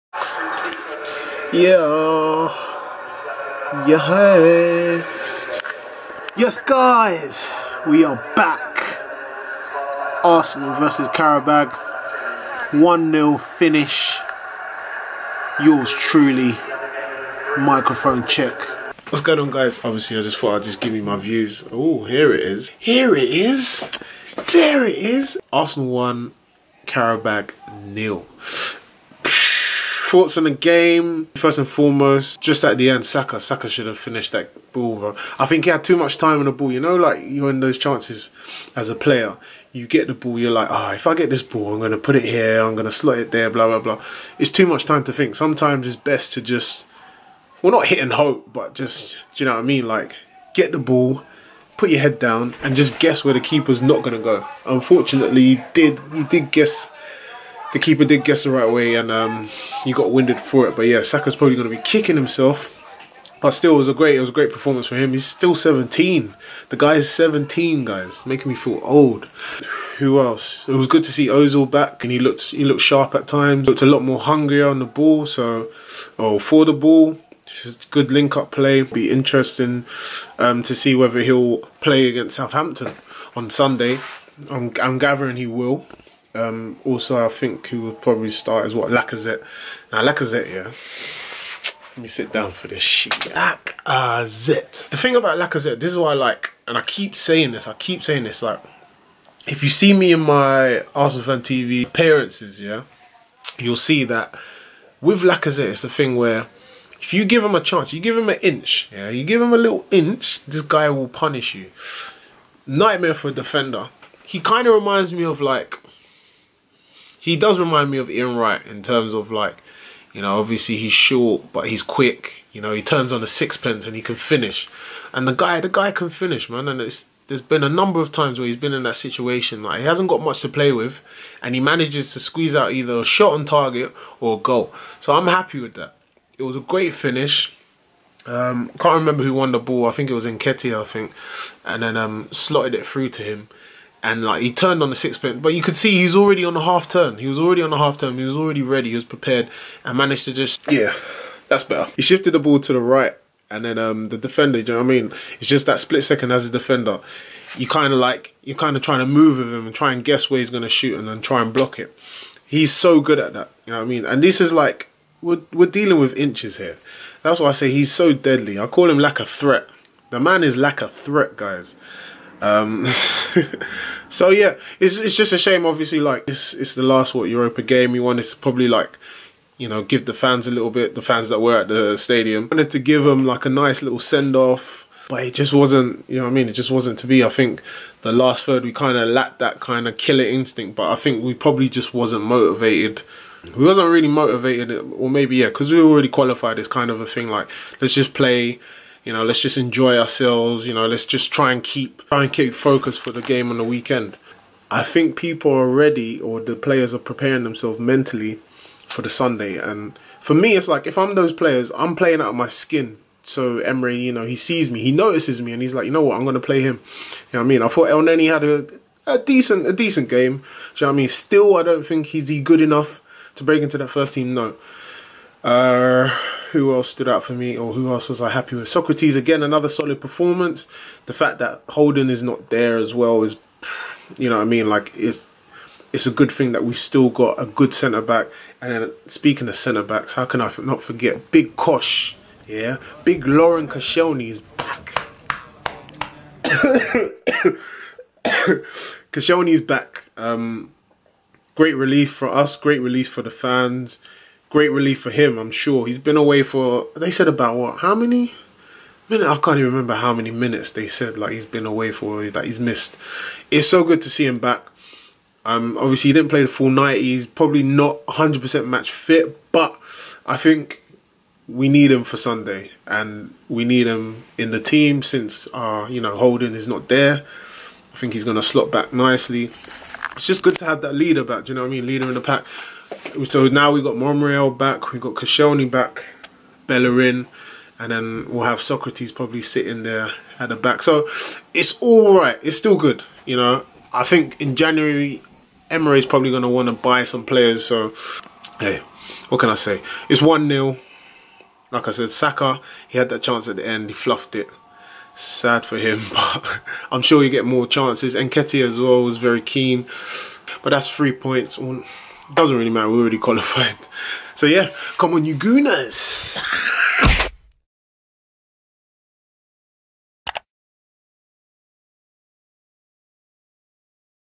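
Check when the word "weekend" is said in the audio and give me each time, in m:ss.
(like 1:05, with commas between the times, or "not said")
3:23.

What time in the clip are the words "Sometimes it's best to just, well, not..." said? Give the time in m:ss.
0:45.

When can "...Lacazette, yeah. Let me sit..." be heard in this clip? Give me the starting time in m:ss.
1:30.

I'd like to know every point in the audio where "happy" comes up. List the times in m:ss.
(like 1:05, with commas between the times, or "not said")
2:15, 3:48.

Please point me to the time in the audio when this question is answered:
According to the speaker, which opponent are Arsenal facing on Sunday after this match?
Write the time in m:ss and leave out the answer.
1:22.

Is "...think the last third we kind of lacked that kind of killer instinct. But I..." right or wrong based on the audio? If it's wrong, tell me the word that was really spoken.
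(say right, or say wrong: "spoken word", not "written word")
right.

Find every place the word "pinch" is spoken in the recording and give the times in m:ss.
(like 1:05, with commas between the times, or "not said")
not said.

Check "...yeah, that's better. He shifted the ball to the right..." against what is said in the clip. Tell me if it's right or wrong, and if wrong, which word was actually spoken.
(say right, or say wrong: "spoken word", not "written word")
right.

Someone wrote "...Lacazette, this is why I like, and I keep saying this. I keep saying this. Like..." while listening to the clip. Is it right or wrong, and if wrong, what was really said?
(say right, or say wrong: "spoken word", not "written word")
right.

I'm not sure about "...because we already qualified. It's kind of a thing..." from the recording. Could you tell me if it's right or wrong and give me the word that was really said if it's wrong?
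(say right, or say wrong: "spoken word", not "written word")
right.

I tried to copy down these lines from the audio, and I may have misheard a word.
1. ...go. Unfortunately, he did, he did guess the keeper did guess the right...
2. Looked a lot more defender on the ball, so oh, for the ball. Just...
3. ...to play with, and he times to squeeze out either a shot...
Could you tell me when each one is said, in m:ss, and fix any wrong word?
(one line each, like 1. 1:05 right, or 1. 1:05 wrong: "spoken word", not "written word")
1. 0:54 right
2. 1:13 wrong: "hungrier", not "defender"
3. 2:10 wrong: "manages", not "times".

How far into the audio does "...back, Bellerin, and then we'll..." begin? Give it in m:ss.
4:45.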